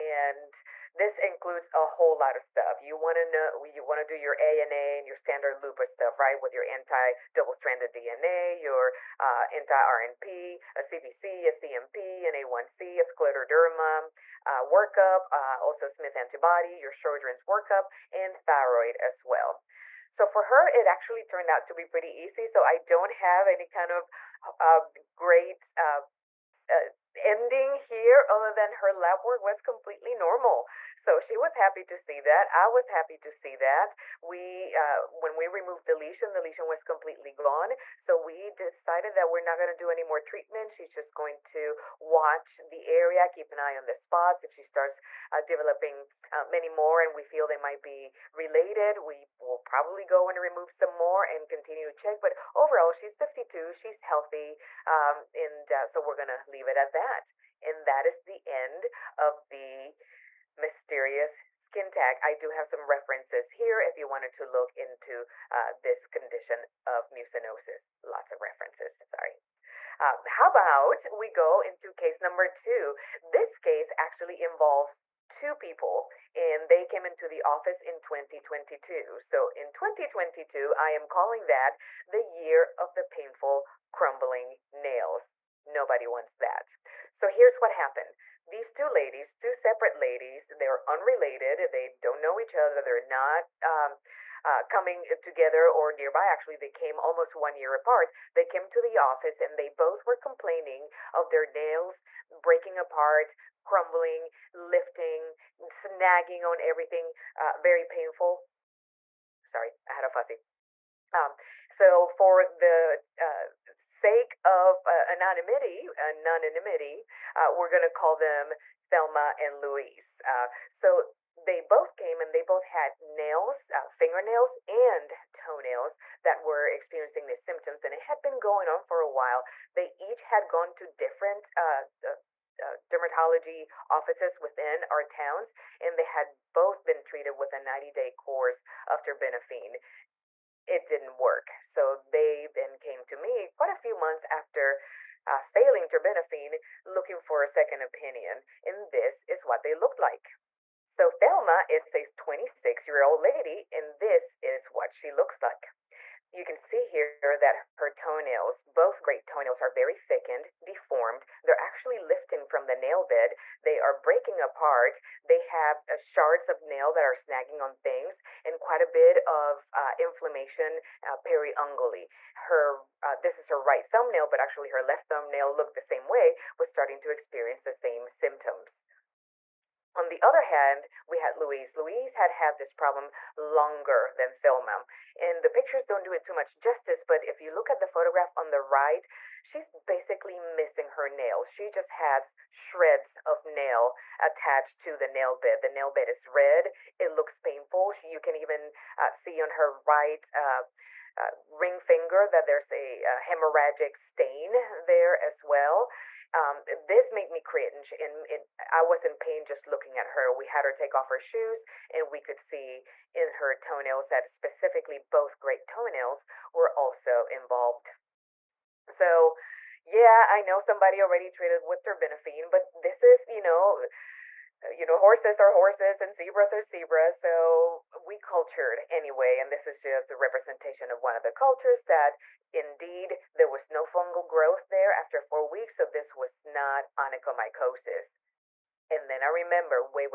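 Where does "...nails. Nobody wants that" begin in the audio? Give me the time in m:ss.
1:24.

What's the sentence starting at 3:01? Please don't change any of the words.
Louise had had this problem longer than Thelma.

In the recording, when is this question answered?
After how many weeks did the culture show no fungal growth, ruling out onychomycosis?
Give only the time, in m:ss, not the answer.
3:55.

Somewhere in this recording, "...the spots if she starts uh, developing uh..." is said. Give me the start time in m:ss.
0:43.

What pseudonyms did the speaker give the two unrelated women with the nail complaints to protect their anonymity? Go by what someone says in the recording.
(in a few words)
Thelma and Louise.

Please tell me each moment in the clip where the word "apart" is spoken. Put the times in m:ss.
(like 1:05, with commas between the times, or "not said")
1:37, 1:42, 2:44.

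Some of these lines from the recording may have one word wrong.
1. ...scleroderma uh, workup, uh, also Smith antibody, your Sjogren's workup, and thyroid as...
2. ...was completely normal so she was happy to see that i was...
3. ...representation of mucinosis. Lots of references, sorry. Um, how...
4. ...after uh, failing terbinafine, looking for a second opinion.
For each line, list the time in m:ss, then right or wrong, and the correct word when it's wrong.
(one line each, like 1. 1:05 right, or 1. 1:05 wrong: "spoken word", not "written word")
1. 0:13 right
2. 0:29 right
3. 1:06 wrong: "condition", not "representation"
4. 2:24 right.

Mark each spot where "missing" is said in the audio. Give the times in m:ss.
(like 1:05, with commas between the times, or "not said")
3:10.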